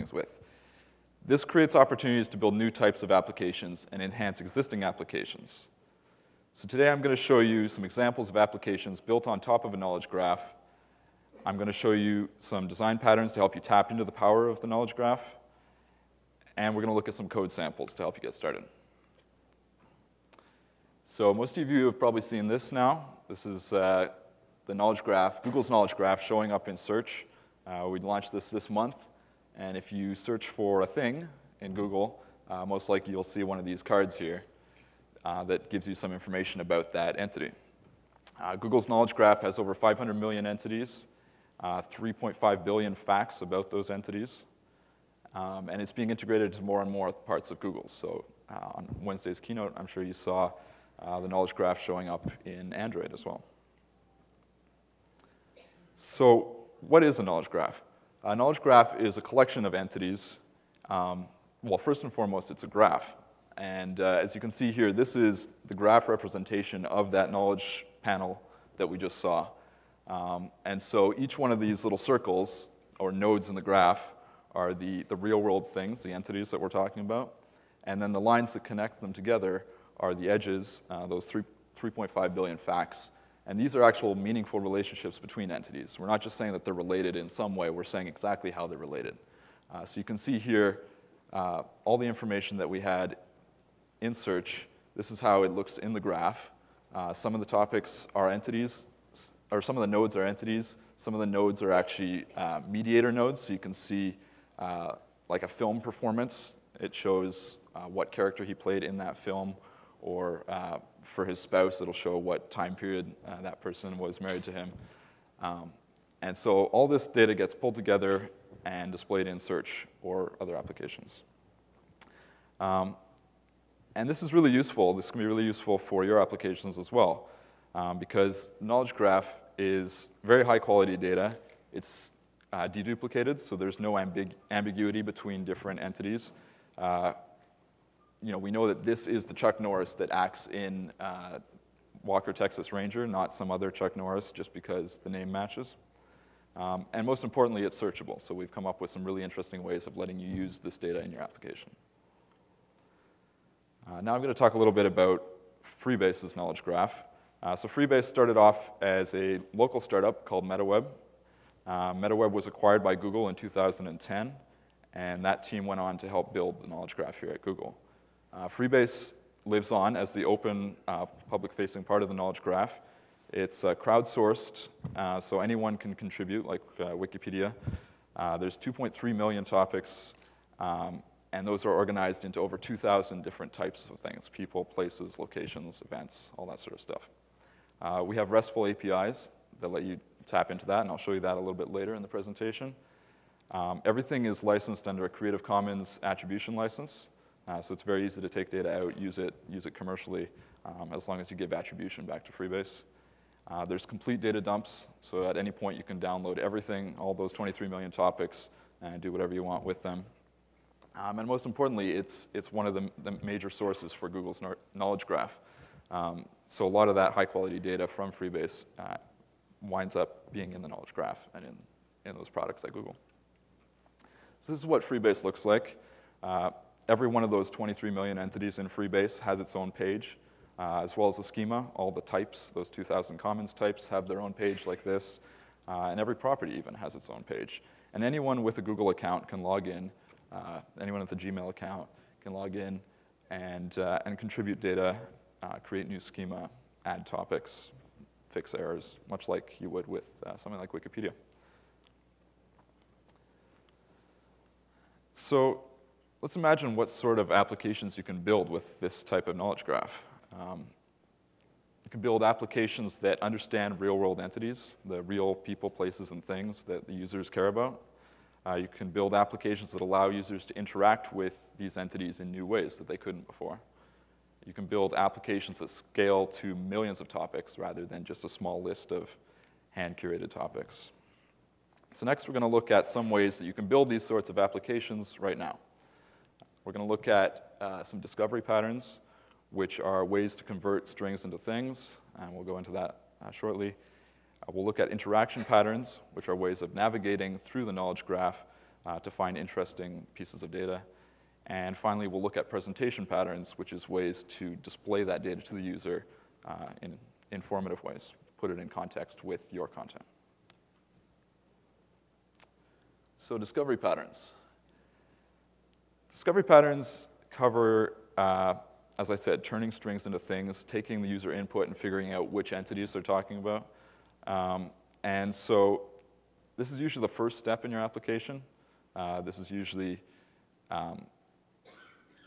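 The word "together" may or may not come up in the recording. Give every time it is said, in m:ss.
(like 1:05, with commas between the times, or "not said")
1:19, 1:57.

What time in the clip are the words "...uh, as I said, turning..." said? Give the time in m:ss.
5:18.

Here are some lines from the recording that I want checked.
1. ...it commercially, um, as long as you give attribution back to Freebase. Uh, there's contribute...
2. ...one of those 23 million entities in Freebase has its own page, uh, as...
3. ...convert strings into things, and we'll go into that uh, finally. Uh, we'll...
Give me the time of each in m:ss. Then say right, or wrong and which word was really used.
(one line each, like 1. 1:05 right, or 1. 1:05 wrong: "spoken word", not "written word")
1. 3:19 wrong: "complete", not "contribute"
2. 3:47 right
3. 4:50 wrong: "shortly", not "finally".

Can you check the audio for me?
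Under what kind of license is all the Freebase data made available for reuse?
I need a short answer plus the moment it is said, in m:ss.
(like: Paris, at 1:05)
Creative Commons attribution, at 3:15.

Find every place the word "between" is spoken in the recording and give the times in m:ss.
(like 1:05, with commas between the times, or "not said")
1:25, 2:15.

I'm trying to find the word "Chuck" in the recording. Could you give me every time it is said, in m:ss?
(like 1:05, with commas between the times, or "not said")
2:19, 2:23.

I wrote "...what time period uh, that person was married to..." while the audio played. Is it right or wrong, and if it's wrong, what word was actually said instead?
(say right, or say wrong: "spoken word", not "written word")
right.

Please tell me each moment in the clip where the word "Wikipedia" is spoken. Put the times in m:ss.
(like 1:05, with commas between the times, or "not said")
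2:56, 4:10.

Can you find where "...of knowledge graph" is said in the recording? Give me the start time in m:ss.
4:19.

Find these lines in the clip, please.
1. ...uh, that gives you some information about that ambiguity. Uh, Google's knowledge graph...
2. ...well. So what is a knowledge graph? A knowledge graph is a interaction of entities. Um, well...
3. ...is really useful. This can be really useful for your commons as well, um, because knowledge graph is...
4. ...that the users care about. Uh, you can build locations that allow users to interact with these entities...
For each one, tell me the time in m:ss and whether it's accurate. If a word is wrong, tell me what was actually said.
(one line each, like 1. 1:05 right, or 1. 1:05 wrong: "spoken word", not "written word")
1. 0:35 wrong: "entity", not "ambiguity"
2. 0:53 wrong: "collection", not "interaction"
3. 2:04 wrong: "applications", not "commons"
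4. 4:26 wrong: "applications", not "locations".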